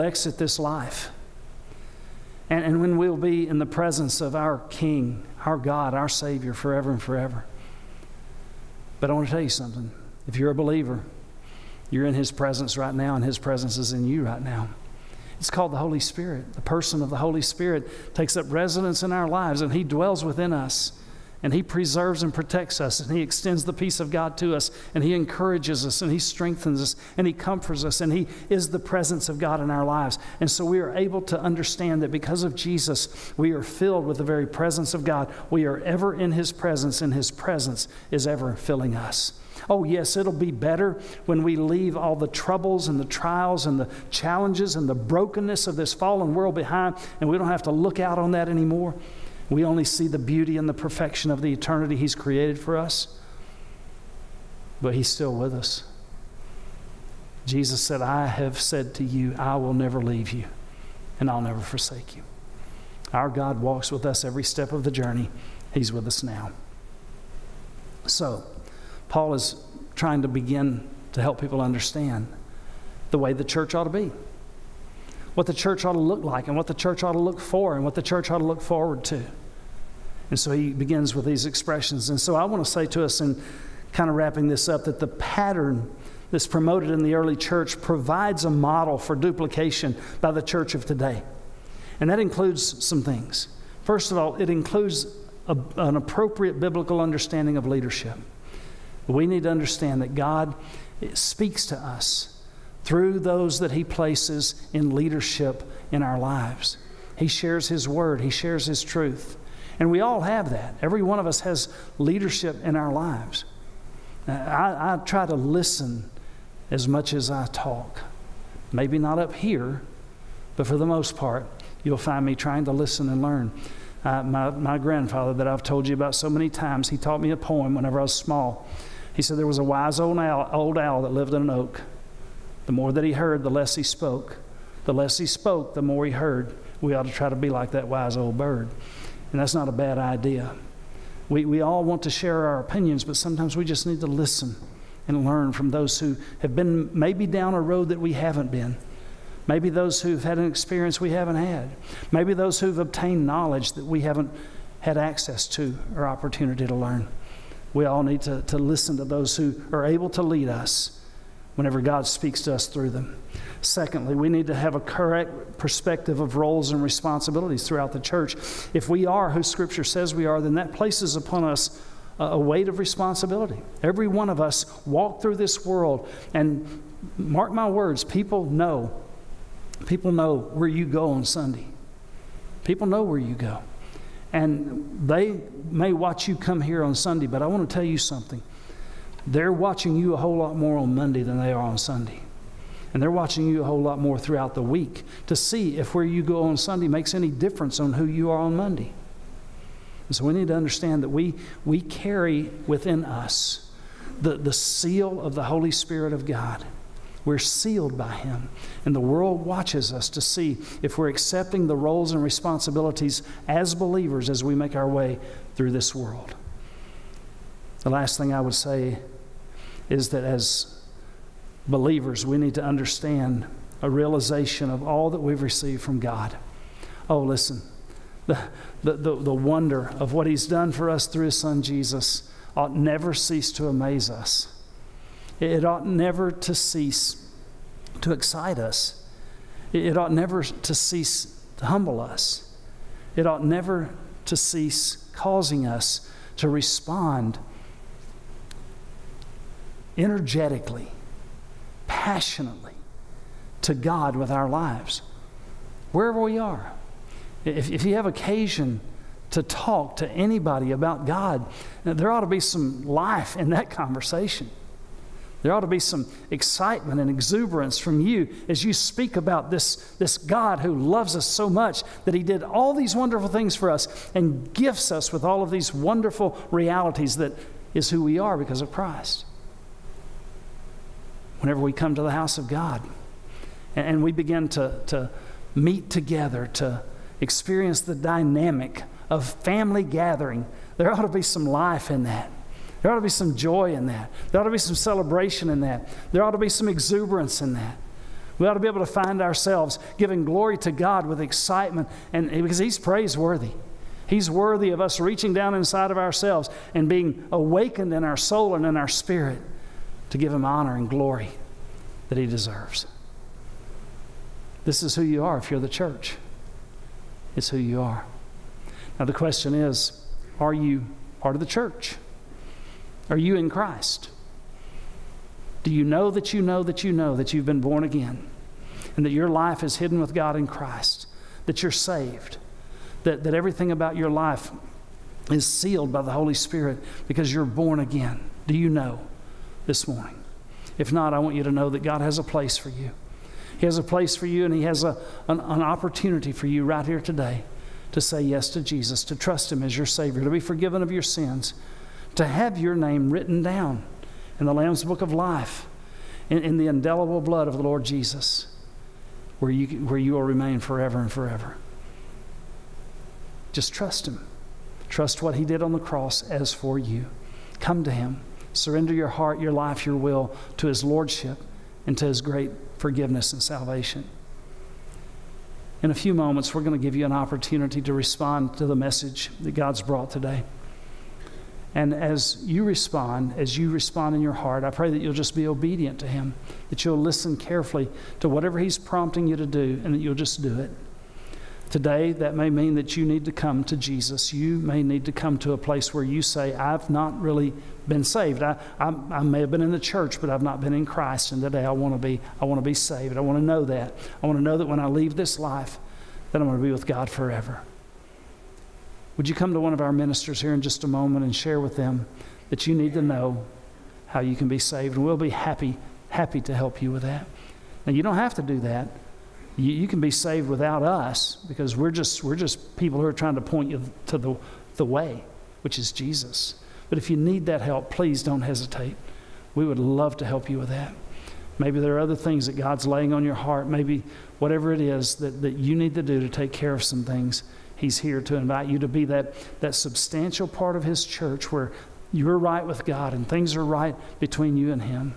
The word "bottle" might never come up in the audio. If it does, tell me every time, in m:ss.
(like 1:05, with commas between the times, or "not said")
not said.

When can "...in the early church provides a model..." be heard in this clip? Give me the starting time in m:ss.
1:26.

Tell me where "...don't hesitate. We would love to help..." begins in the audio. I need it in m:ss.
7:08.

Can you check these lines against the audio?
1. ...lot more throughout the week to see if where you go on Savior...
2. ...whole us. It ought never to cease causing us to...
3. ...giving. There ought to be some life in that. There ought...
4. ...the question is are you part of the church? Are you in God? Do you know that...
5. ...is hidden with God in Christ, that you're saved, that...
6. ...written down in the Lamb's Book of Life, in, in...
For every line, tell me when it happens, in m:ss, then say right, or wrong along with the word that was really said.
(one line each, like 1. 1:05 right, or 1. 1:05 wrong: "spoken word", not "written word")
1. 3:13 wrong: "Sunday", not "Savior"
2. 4:01 wrong: "humble", not "whole"
3. 4:49 wrong: "gathering", not "giving"
4. 5:19 wrong: "Christ", not "God"
5. 5:29 right
6. 5:53 right.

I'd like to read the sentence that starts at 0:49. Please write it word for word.
We only see the beauty and the perfection of the eternity He's created for us, but He's still with us.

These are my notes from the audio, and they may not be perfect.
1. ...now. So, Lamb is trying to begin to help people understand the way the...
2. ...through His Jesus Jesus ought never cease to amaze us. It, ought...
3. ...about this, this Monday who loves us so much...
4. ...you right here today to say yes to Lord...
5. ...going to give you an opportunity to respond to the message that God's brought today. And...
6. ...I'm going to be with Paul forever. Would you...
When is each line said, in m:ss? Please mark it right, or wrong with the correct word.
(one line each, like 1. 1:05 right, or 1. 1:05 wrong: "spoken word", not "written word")
1. 1:06 wrong: "Paul", not "Lamb"
2. 3:51 wrong: "Son", not "Jesus"
3. 4:29 wrong: "God", not "Monday"
4. 5:46 wrong: "Jesus", not "Lord"
5. 6:16 right
6. 6:46 wrong: "God", not "Paul".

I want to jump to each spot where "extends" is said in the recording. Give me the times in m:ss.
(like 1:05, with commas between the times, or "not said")
0:23.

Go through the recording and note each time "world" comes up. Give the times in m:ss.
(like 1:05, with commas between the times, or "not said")
0:46, 2:55, 3:29, 3:35.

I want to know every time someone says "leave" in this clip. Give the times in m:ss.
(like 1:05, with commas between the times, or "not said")
0:41, 1:00, 6:44.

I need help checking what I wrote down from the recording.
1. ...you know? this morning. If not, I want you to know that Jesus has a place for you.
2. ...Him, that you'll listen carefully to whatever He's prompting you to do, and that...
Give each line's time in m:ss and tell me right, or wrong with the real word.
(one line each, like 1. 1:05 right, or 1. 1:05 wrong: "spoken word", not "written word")
1. 5:38 wrong: "God", not "Jesus"
2. 6:26 right.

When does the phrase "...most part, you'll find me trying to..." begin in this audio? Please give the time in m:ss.
2:00.